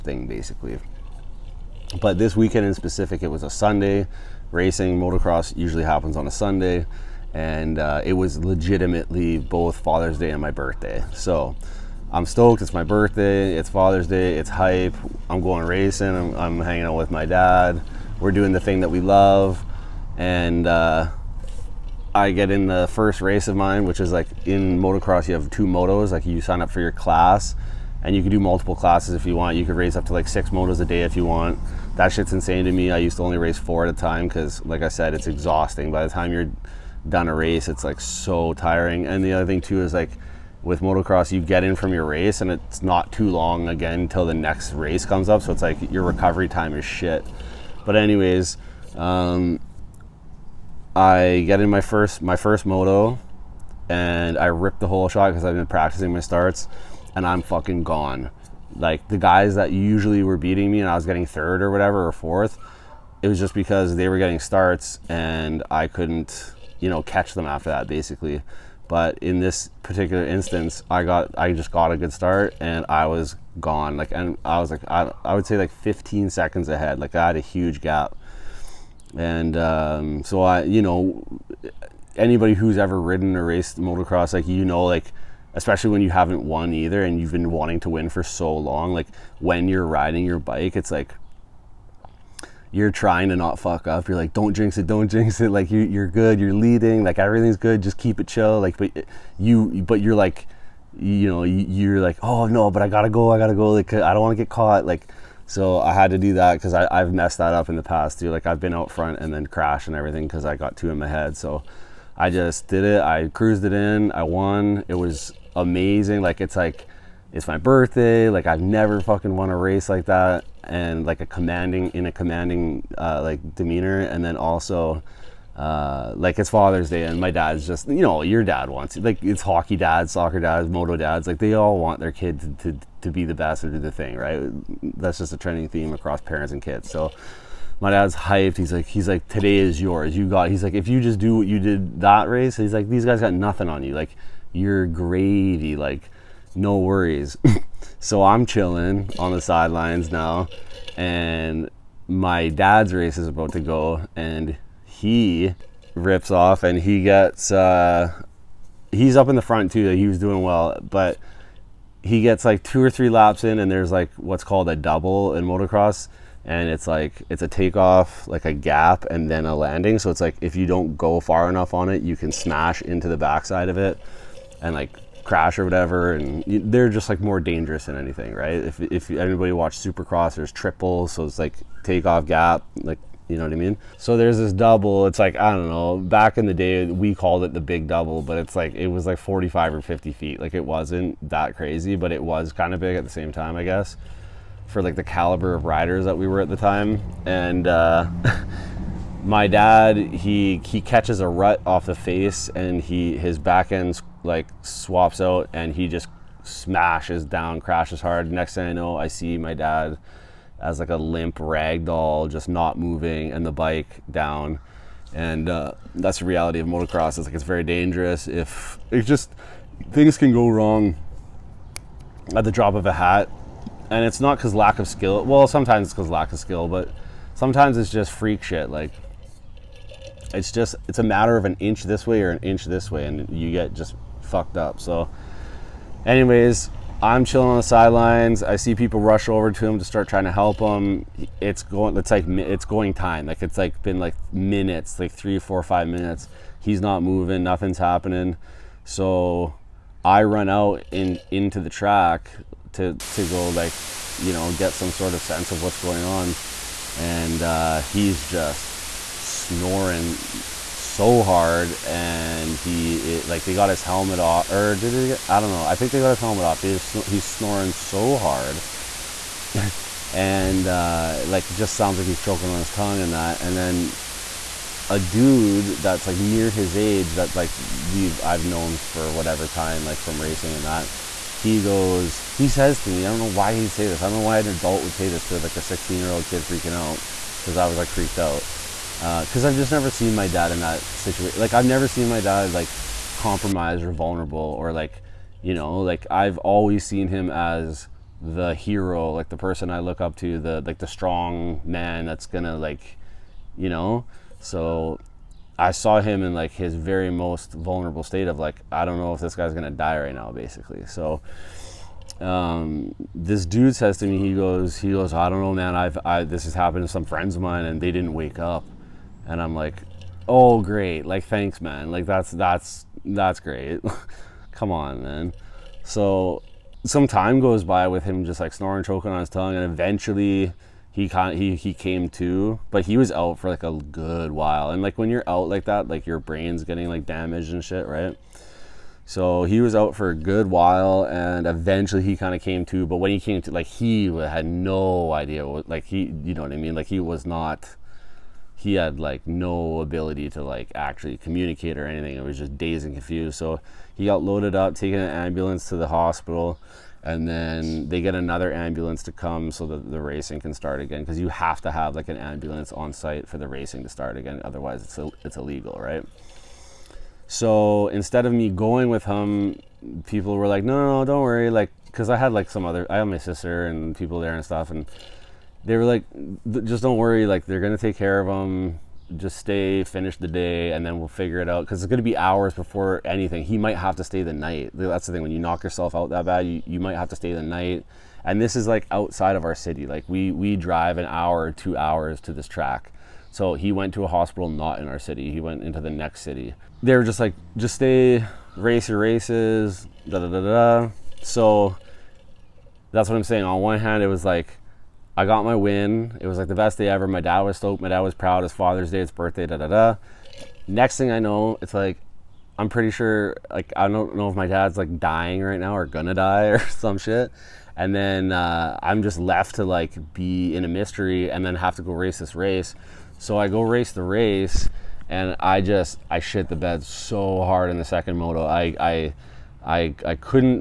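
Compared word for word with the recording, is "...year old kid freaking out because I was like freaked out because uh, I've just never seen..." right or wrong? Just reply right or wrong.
right.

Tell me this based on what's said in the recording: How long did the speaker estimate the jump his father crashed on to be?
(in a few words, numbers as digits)
45 or 50 feet.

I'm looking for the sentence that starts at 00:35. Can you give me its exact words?
By the time you're done a race, it's like so tiring.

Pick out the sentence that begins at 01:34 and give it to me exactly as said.
You're like, don't jinx it, don't jinx it.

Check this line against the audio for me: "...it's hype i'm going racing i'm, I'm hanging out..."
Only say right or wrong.
right.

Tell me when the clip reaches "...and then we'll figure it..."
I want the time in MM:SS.
06:20.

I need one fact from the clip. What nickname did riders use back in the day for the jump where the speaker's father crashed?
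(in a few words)
the big double.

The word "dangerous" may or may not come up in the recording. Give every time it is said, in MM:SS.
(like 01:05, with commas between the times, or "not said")
02:57, 03:37.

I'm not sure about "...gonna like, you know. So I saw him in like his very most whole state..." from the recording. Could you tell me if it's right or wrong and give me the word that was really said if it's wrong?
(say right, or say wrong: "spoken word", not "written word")
wrong: "vulnerable", not "whole".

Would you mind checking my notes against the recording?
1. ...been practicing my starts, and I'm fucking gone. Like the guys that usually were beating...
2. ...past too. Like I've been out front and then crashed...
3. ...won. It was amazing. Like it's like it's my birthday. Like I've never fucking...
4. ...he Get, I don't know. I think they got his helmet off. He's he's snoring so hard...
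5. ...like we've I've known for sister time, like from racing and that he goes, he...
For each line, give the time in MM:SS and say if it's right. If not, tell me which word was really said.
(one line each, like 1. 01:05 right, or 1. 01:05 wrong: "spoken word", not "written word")
1. 00:55 right
2. 01:47 right
3. 01:54 right
4. 04:24 right
5. 04:37 wrong: "whatever", not "sister".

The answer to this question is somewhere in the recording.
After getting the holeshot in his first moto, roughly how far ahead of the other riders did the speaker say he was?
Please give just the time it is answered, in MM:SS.
01:15.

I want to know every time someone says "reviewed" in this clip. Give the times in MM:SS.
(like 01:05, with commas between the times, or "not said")
not said.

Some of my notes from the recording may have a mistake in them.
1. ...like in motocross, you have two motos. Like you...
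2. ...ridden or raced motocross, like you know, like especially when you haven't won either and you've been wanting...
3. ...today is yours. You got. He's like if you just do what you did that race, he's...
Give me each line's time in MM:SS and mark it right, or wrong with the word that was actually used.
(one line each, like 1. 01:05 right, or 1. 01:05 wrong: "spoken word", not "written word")
1. 00:24 right
2. 01:23 right
3. 02:19 right.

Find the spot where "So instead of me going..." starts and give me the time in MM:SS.
06:07.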